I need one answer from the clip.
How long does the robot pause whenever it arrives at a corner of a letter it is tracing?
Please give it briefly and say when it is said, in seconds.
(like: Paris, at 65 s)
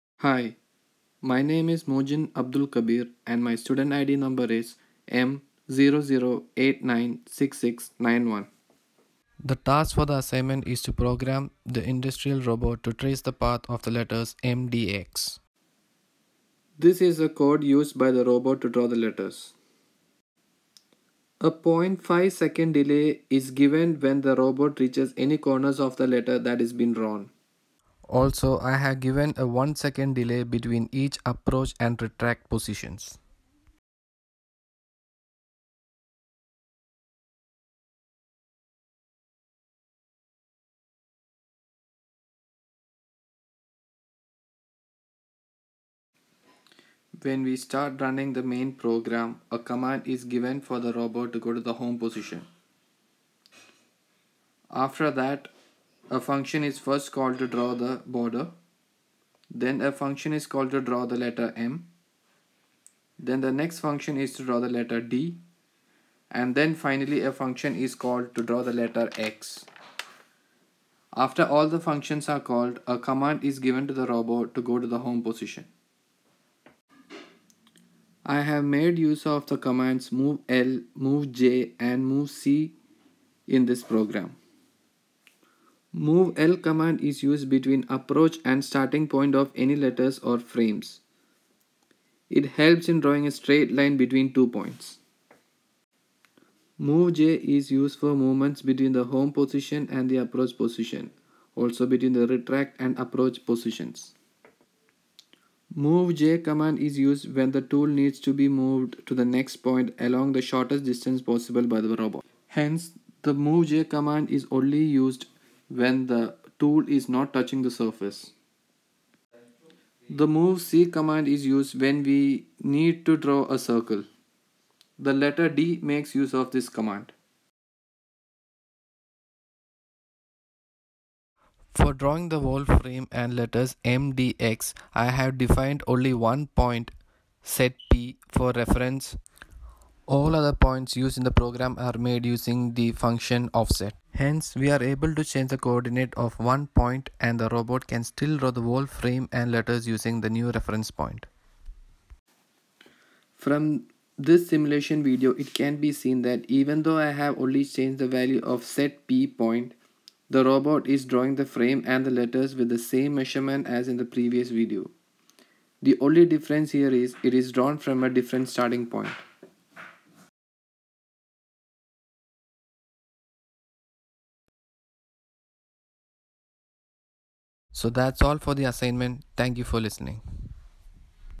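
0.5 seconds, at 21 s.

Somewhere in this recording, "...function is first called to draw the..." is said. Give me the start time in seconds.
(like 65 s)
56 s.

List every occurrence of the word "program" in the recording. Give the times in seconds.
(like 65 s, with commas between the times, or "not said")
10 s, 48 s, 83 s, 141 s.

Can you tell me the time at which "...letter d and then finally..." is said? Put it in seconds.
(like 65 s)
64 s.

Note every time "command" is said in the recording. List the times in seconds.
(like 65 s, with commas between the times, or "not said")
49 s, 73 s, 79 s, 86 s, 106 s, 113 s, 120 s, 126 s.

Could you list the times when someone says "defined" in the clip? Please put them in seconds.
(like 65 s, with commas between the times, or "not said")
135 s.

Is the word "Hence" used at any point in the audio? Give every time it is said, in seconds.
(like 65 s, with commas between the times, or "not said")
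112 s, 144 s.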